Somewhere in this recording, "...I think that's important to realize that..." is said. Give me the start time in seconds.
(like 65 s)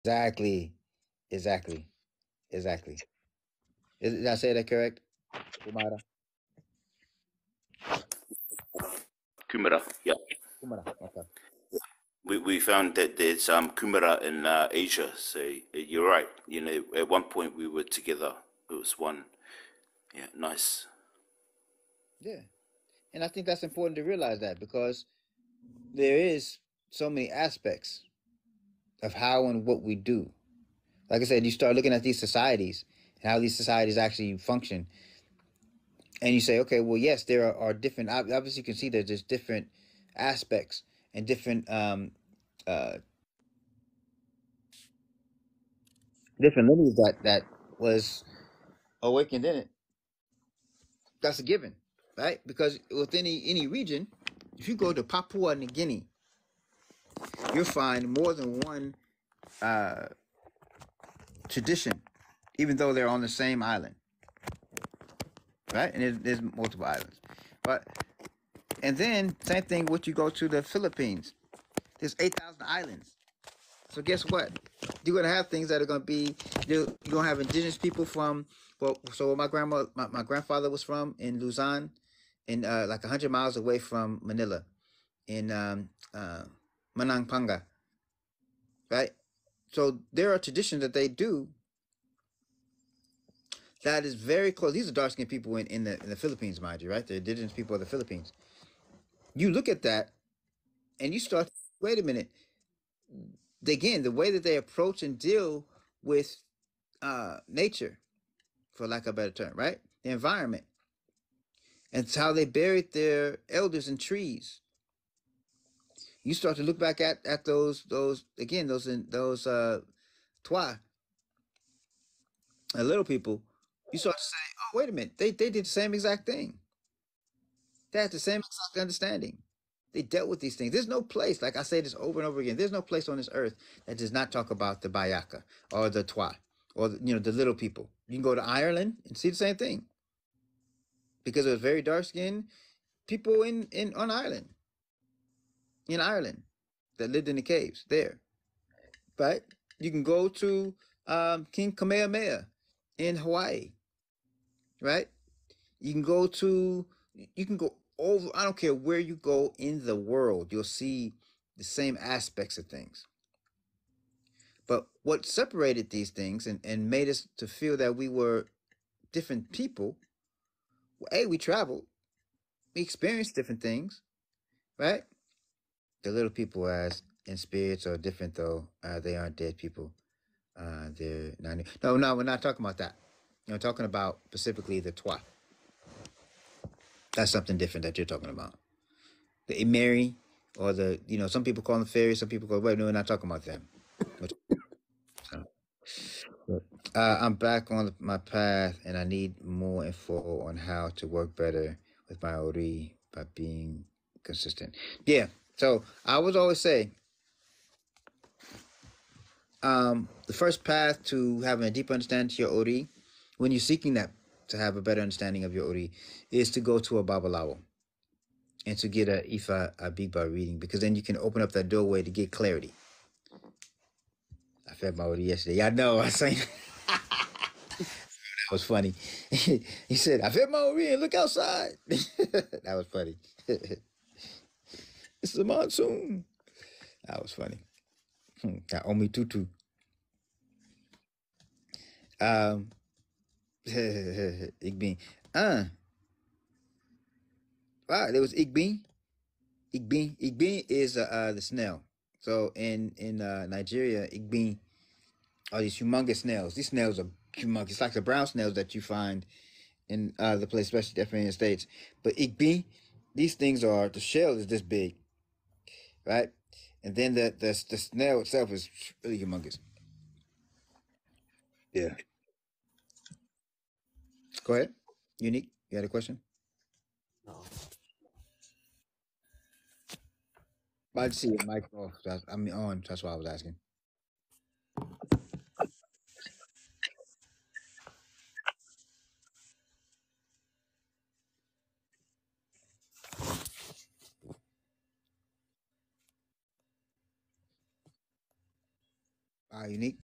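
23 s.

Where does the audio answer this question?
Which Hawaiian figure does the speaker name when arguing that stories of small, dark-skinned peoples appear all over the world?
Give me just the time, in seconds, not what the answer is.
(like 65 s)
151 s.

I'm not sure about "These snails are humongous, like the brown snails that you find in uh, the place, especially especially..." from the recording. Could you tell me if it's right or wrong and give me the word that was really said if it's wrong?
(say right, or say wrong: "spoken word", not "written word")
wrong: "definitely", not "especially".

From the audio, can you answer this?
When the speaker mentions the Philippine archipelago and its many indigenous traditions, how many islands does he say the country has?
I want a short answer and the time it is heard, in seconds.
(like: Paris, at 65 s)
8,000, at 72 s.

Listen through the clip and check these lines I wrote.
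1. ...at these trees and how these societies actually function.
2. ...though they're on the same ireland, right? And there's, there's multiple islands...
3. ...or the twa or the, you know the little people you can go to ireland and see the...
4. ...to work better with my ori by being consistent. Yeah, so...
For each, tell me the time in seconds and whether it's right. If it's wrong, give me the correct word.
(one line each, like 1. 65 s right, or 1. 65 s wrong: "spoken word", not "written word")
1. 31 s wrong: "societies", not "trees"
2. 62 s wrong: "island", not "ireland"
3. 135 s right
4. 200 s right.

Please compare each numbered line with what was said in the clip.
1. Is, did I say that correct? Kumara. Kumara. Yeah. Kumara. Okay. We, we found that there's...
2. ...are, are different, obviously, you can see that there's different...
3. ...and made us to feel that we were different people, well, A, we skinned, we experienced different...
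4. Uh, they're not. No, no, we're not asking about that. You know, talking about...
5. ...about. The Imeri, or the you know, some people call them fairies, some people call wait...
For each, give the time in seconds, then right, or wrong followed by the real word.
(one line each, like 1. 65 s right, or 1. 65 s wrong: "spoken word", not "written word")
1. 3 s right
2. 37 s right
3. 166 s wrong: "traveled", not "skinned"
4. 180 s wrong: "talking", not "asking"
5. 188 s right.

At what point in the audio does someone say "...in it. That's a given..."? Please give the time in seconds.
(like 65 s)
49 s.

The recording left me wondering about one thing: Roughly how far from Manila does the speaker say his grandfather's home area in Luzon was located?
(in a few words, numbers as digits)
100 miles.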